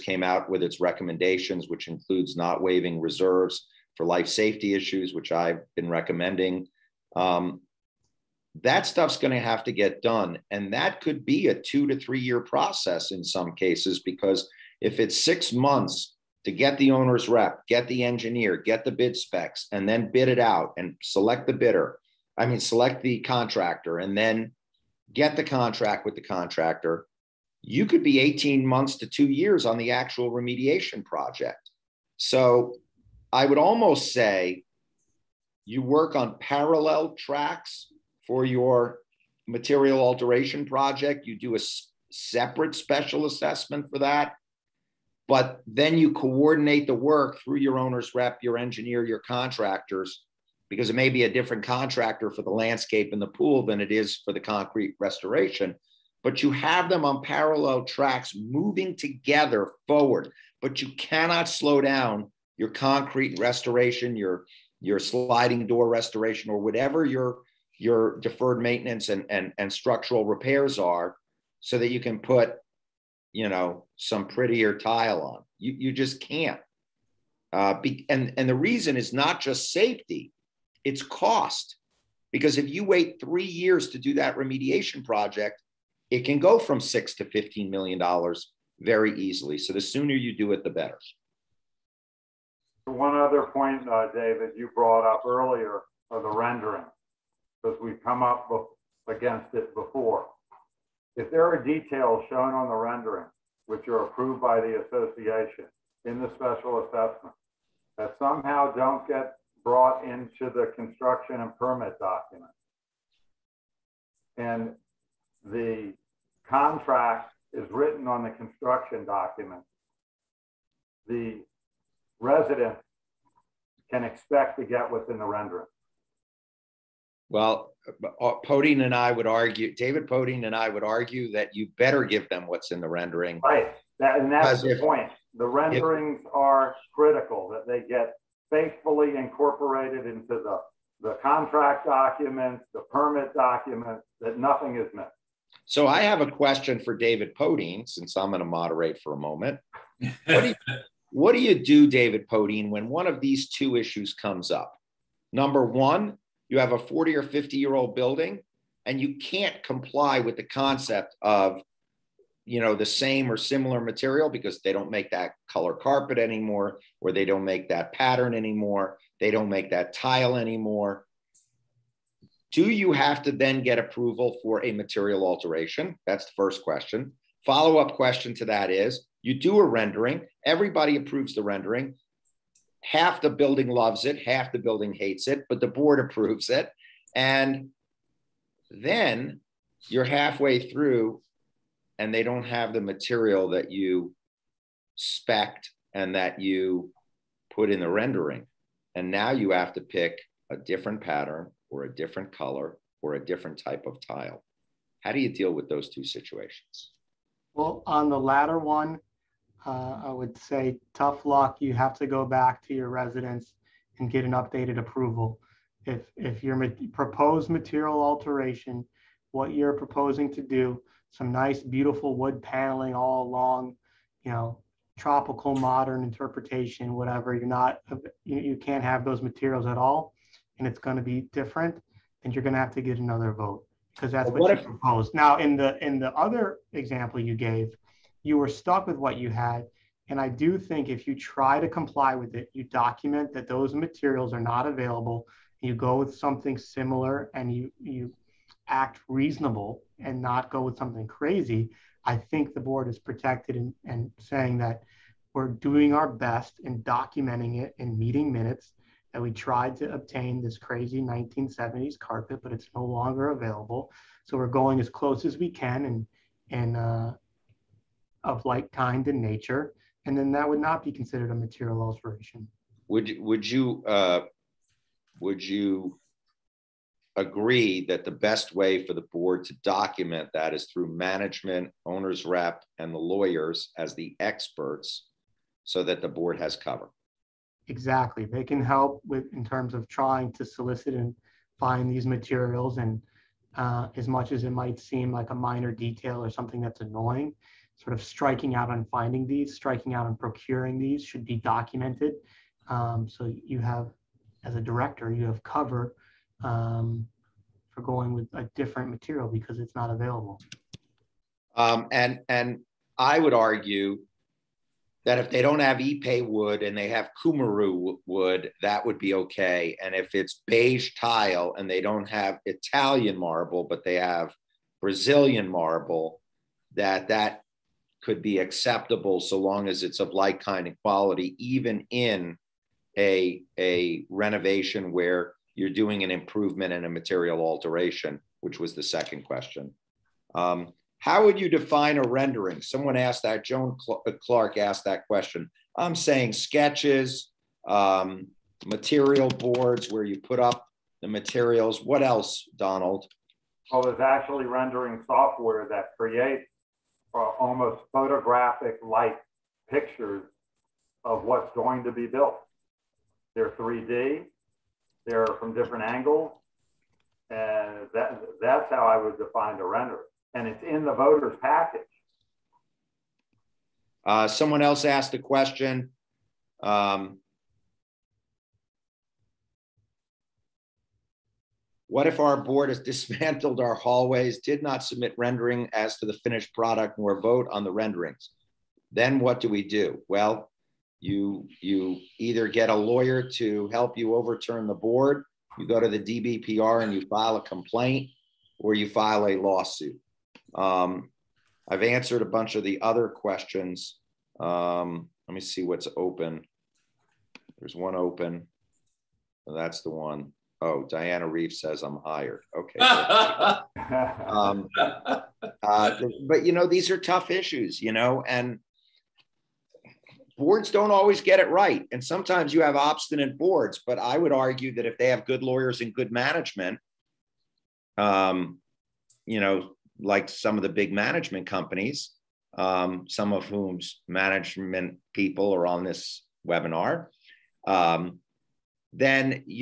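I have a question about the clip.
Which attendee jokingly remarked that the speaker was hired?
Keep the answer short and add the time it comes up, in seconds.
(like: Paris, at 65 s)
Diana Reeve, at 410 s.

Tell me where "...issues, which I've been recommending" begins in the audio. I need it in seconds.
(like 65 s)
4 s.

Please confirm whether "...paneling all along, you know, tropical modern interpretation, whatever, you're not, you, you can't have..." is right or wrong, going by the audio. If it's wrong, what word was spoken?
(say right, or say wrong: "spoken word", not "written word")
right.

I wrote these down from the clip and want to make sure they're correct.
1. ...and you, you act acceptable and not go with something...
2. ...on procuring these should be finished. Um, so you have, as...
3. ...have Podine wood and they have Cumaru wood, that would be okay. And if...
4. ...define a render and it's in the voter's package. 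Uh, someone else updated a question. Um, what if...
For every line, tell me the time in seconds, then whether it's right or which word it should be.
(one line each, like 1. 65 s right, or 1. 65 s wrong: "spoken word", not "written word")
1. 247 s wrong: "reasonable", not "acceptable"
2. 300 s wrong: "documented", not "finished"
3. 315 s wrong: "Ipe", not "Podine"
4. 369 s wrong: "asked", not "updated".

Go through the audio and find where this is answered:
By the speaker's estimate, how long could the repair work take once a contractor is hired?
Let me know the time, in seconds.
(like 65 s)
28 s.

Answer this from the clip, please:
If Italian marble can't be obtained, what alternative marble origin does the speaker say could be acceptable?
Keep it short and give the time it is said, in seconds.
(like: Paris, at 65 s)
Brazilian marble, at 324 s.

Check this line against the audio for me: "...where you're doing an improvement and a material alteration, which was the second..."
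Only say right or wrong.
right.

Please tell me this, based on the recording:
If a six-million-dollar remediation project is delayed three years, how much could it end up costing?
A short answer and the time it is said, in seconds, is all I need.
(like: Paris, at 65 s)
$15 million, at 87 s.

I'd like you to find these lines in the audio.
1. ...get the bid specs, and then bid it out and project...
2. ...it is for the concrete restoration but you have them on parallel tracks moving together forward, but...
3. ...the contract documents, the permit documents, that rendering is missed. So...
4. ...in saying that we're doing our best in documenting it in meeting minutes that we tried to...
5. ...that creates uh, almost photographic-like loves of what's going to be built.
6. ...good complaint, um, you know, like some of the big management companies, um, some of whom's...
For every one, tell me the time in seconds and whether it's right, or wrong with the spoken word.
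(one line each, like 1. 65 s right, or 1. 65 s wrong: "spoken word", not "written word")
1. 18 s wrong: "select", not "project"
2. 53 s right
3. 140 s wrong: "nothing", not "rendering"
4. 253 s right
5. 355 s wrong: "pictures", not "loves"
6. 425 s wrong: "management", not "complaint".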